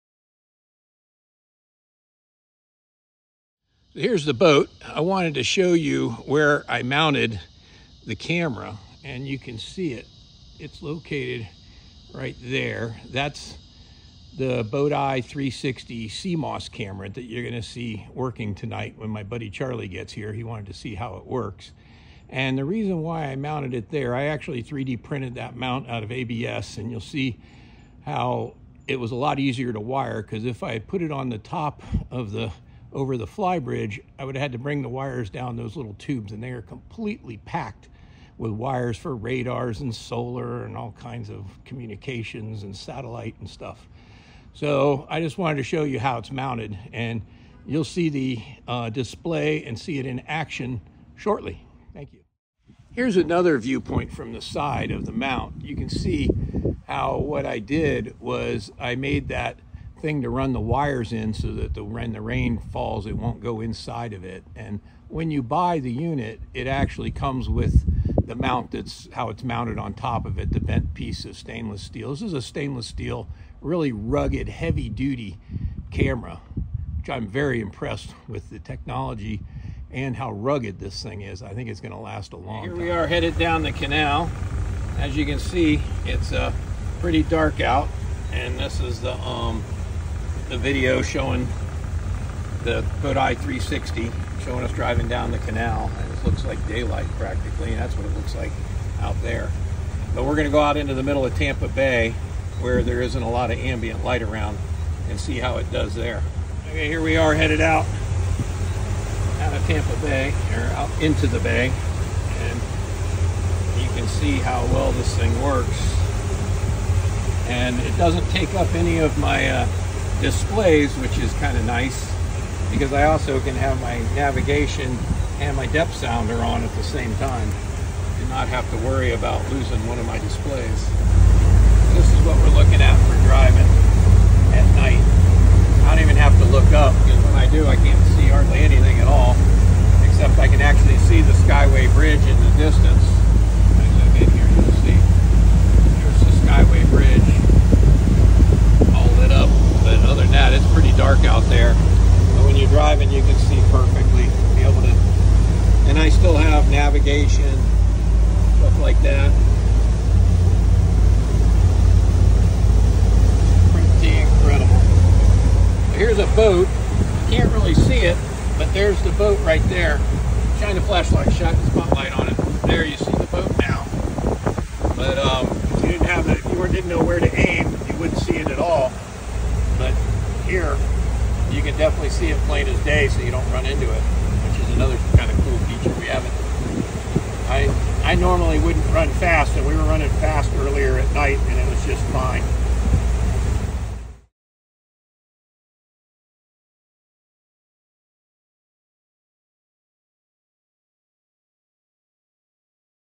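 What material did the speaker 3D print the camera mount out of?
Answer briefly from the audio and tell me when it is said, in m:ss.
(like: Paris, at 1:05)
ABS, at 0:26.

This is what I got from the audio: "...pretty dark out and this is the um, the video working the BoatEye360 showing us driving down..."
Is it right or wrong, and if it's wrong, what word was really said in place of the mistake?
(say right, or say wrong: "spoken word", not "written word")
wrong: "showing", not "working".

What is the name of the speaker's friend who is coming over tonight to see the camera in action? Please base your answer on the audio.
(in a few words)
Charlie.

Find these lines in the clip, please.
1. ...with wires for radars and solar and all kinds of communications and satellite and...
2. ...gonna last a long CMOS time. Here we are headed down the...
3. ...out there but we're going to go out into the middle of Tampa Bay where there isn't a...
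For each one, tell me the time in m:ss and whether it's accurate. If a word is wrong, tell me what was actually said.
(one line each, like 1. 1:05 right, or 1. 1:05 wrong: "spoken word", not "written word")
1. 0:38 right
2. 1:21 wrong: "Here", not "CMOS"
3. 1:38 right.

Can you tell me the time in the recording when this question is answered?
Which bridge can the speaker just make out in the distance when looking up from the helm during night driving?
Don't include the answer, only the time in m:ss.
2:21.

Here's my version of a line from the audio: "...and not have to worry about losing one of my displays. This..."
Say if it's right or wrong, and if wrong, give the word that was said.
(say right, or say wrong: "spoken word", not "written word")
right.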